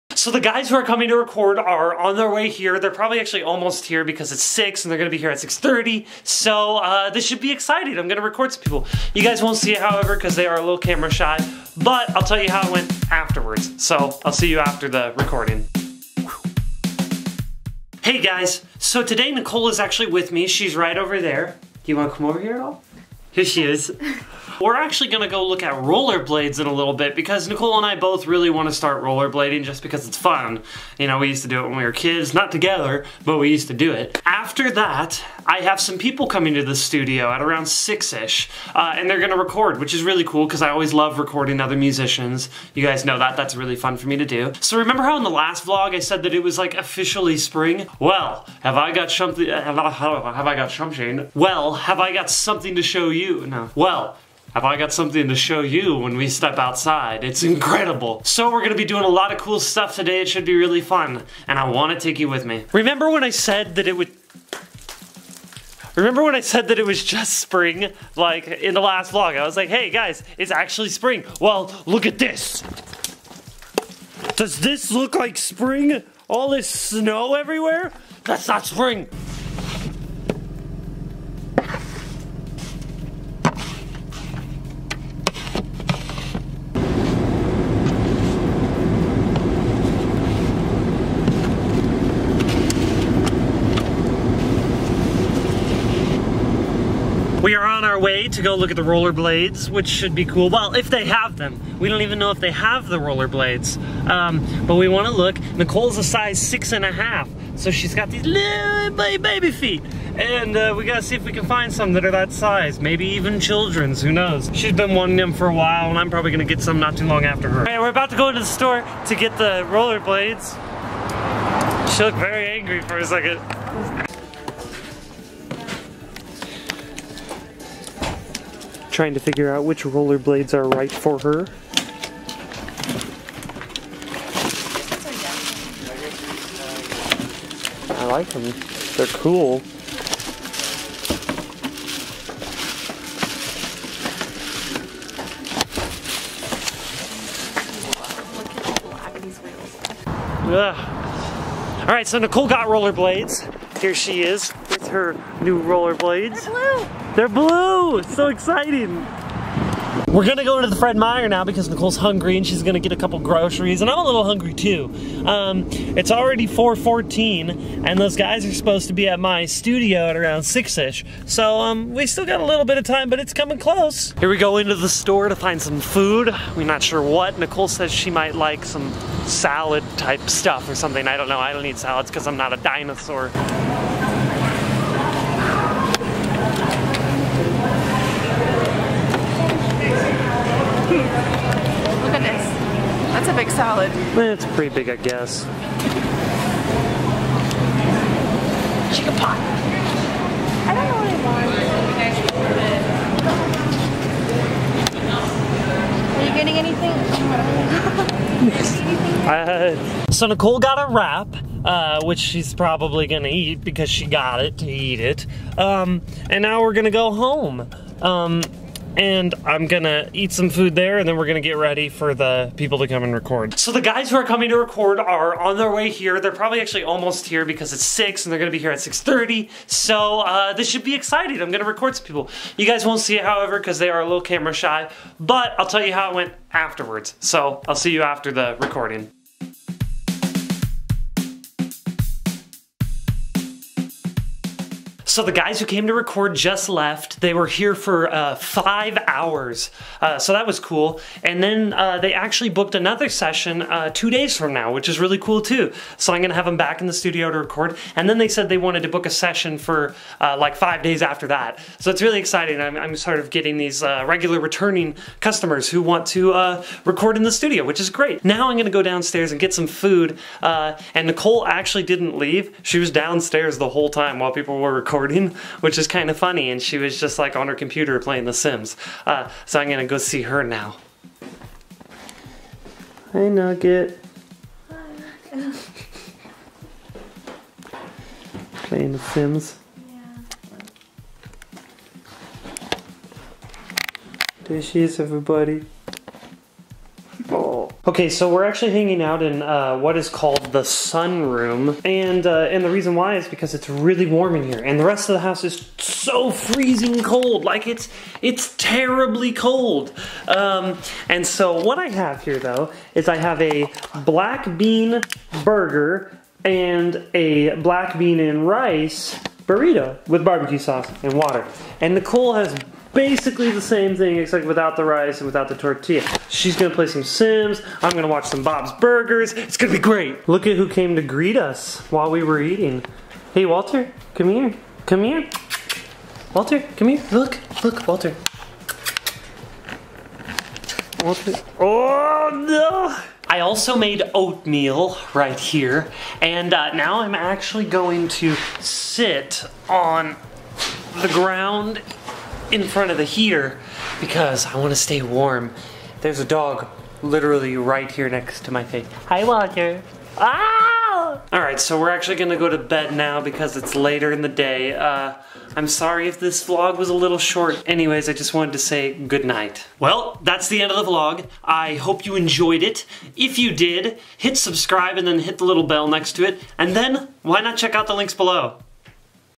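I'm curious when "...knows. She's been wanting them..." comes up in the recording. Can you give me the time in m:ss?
1:54.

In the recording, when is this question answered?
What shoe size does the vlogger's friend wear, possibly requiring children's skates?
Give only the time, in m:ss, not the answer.
1:46.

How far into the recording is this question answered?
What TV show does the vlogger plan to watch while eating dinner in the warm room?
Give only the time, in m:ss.
5:28.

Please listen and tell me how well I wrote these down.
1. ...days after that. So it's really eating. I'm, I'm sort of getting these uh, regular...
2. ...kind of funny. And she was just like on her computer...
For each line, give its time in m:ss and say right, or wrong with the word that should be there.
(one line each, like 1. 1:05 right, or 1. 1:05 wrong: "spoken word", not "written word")
1. 4:20 wrong: "exciting", not "eating"
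2. 4:35 right.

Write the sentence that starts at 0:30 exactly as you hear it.
You know, we used to do it when we were kids, not together, but we used to do it.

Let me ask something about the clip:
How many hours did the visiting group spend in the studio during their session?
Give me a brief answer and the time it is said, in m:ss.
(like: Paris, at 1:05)
5, at 4:08.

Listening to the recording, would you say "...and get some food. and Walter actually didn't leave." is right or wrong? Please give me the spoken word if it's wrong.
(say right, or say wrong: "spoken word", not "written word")
wrong: "Nicole", not "Walter".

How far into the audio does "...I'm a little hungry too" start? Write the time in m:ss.
2:43.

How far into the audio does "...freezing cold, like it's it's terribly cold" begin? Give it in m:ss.
5:06.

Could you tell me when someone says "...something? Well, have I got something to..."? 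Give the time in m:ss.
0:50.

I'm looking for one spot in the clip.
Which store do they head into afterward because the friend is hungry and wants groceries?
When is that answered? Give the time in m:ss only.
2:40.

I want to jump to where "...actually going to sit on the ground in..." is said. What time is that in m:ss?
5:47.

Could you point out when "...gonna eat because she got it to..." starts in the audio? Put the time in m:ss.
3:33.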